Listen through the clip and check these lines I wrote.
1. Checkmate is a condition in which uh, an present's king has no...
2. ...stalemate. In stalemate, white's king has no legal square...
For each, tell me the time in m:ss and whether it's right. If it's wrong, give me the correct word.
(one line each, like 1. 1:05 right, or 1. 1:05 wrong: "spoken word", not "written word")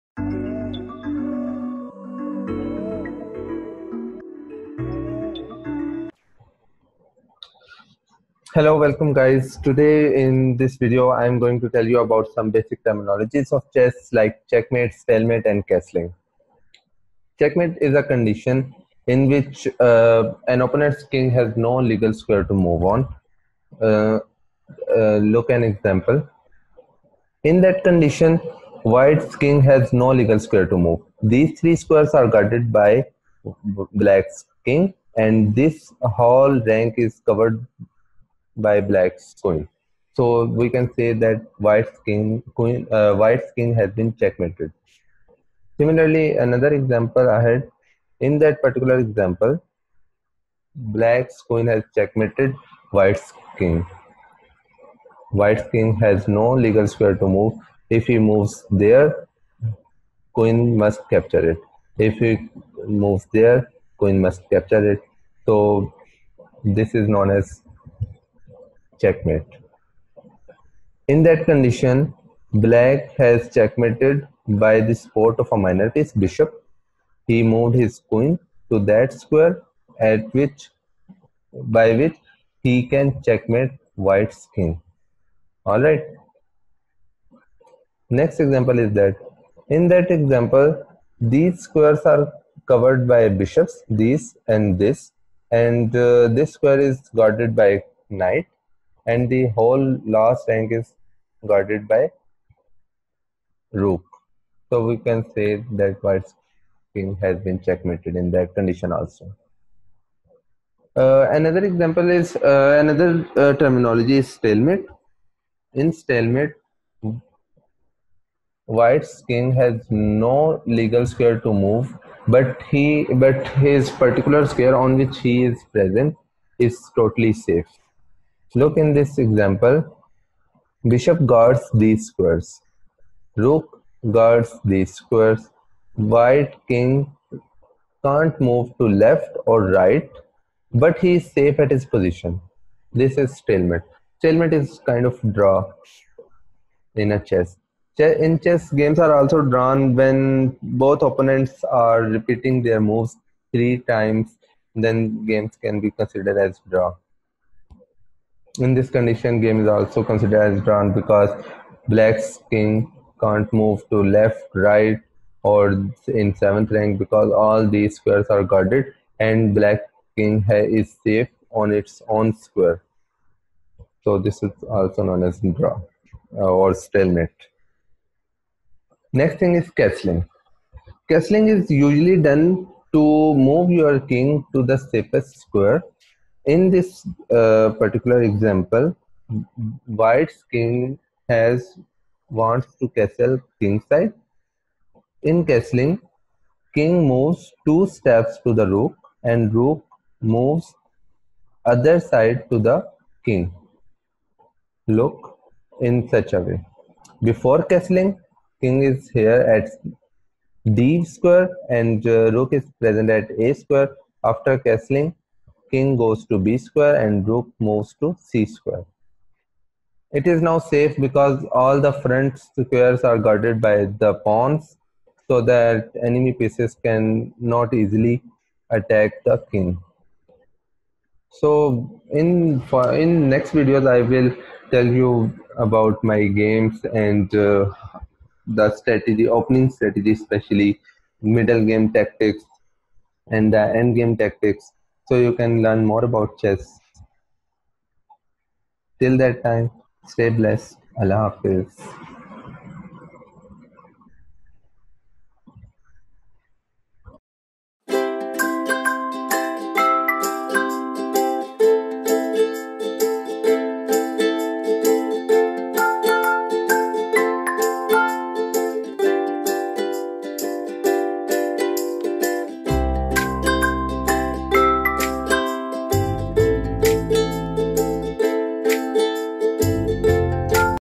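1. 0:17 wrong: "opponent", not "present"
2. 1:54 right.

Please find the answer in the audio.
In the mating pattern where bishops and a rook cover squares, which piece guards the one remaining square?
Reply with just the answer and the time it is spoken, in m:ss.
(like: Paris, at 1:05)
Knight, at 1:38.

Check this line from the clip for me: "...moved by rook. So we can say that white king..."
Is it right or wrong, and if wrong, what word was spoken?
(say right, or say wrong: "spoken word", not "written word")
wrong: "guarded", not "moved".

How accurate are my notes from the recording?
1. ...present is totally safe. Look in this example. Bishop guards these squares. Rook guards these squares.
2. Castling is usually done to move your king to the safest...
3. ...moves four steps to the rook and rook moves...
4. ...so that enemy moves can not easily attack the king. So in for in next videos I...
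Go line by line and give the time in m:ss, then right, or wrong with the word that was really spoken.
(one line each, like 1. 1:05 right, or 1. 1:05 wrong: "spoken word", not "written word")
1. 2:05 right
2. 3:01 right
3. 3:17 wrong: "two", not "four"
4. 3:45 wrong: "pieces", not "moves".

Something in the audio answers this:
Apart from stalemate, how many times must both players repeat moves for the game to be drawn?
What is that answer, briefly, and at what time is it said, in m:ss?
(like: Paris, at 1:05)
3, at 2:33.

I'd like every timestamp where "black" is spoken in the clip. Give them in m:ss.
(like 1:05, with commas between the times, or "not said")
0:33, 0:38, 0:50, 1:12, 2:41, 2:49.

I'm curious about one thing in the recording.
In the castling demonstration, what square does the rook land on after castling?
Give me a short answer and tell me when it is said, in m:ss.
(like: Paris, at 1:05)
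c square, at 3:38.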